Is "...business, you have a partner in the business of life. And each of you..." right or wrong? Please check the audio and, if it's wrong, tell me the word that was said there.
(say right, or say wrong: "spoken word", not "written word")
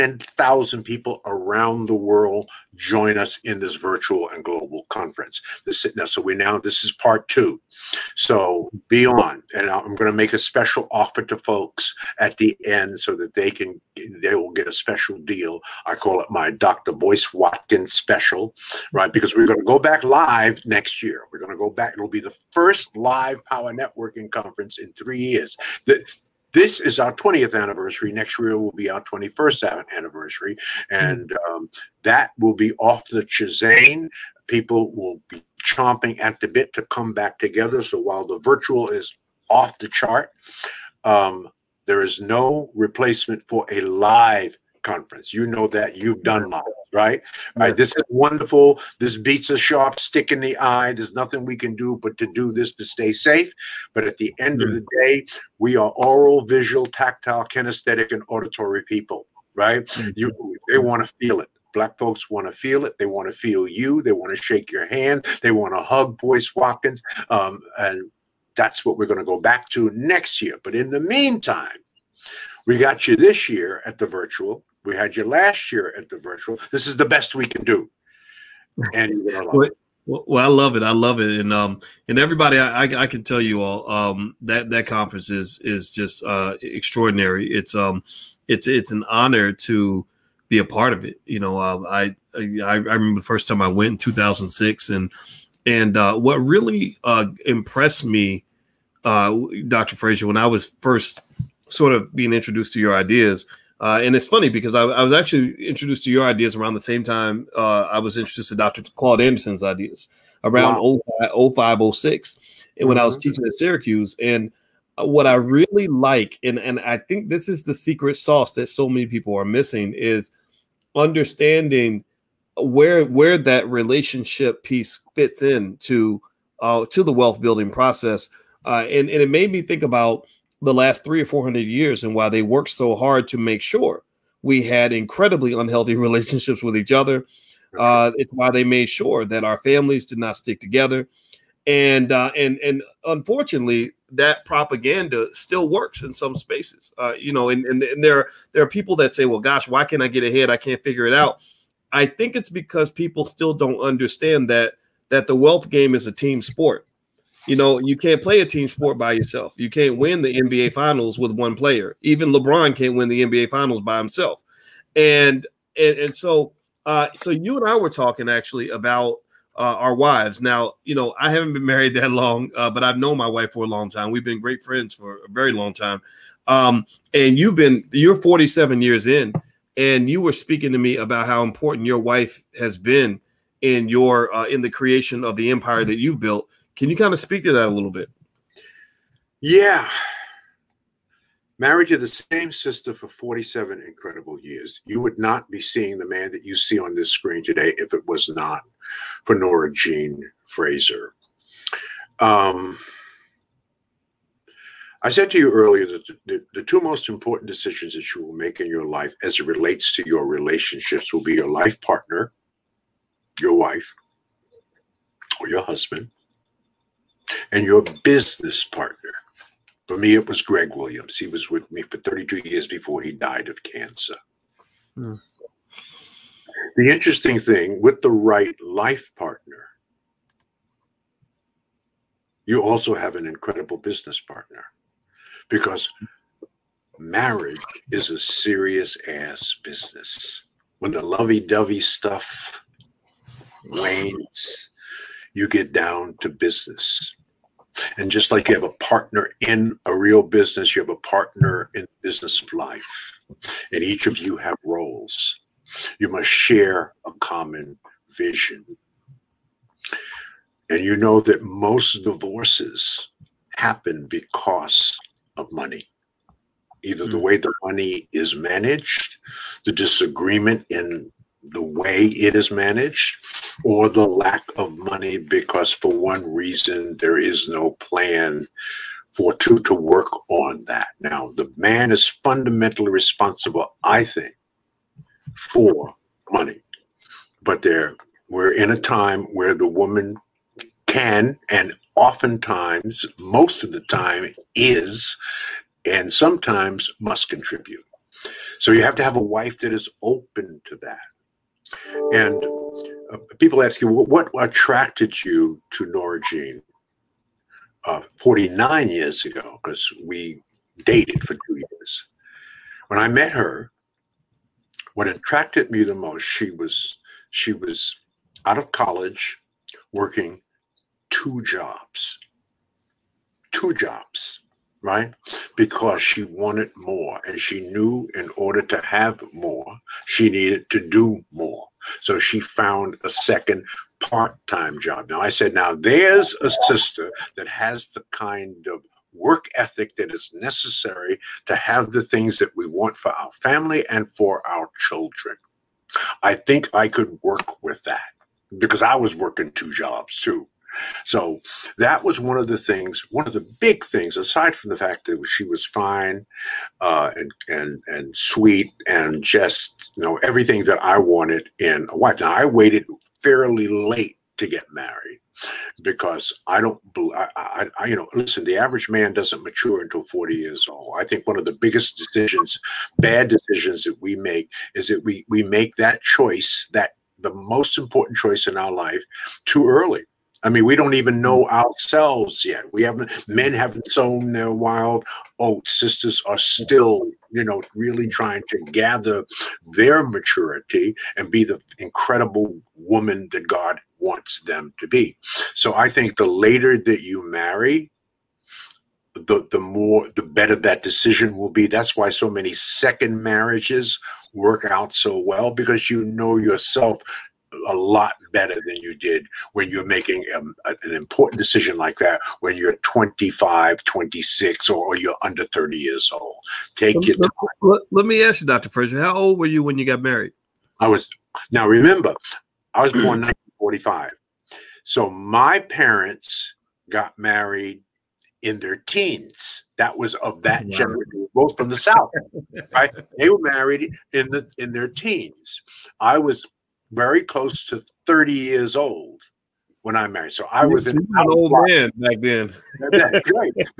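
right.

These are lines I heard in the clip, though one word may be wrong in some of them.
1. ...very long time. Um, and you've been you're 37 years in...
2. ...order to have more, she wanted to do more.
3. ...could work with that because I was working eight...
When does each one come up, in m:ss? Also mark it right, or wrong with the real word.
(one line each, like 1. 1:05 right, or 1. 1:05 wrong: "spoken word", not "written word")
1. 2:55 wrong: "47", not "37"
2. 5:28 wrong: "needed", not "wanted"
3. 5:46 wrong: "two", not "eight".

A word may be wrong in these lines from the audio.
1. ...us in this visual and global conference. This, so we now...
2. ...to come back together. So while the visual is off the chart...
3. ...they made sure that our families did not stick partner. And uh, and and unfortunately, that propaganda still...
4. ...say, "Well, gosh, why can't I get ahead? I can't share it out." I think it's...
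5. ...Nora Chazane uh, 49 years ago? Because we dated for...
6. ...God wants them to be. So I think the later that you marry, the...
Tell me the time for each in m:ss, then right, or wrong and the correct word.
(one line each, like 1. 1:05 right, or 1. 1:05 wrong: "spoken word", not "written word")
1. 0:03 wrong: "virtual", not "visual"
2. 0:36 wrong: "virtual", not "visual"
3. 2:18 wrong: "together", not "partner"
4. 2:29 wrong: "figure", not "share"
5. 5:05 wrong: "Jean", not "Chazane"
6. 6:33 right.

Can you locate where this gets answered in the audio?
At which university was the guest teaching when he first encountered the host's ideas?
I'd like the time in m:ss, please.
1:53.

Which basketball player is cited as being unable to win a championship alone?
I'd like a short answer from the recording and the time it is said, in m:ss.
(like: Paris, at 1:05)
LeBron, at 2:42.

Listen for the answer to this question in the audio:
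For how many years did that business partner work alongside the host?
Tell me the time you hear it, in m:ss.
3:41.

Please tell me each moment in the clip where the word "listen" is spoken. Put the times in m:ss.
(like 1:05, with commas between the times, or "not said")
6:08.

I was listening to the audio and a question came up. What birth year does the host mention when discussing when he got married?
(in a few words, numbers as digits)
1945.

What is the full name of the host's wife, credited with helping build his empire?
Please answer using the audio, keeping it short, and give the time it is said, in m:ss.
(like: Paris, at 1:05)
Nora Jean Fraser, at 3:19.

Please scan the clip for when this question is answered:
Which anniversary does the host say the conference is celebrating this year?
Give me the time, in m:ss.
0:27.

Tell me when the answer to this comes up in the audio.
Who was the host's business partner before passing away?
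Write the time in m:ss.
3:40.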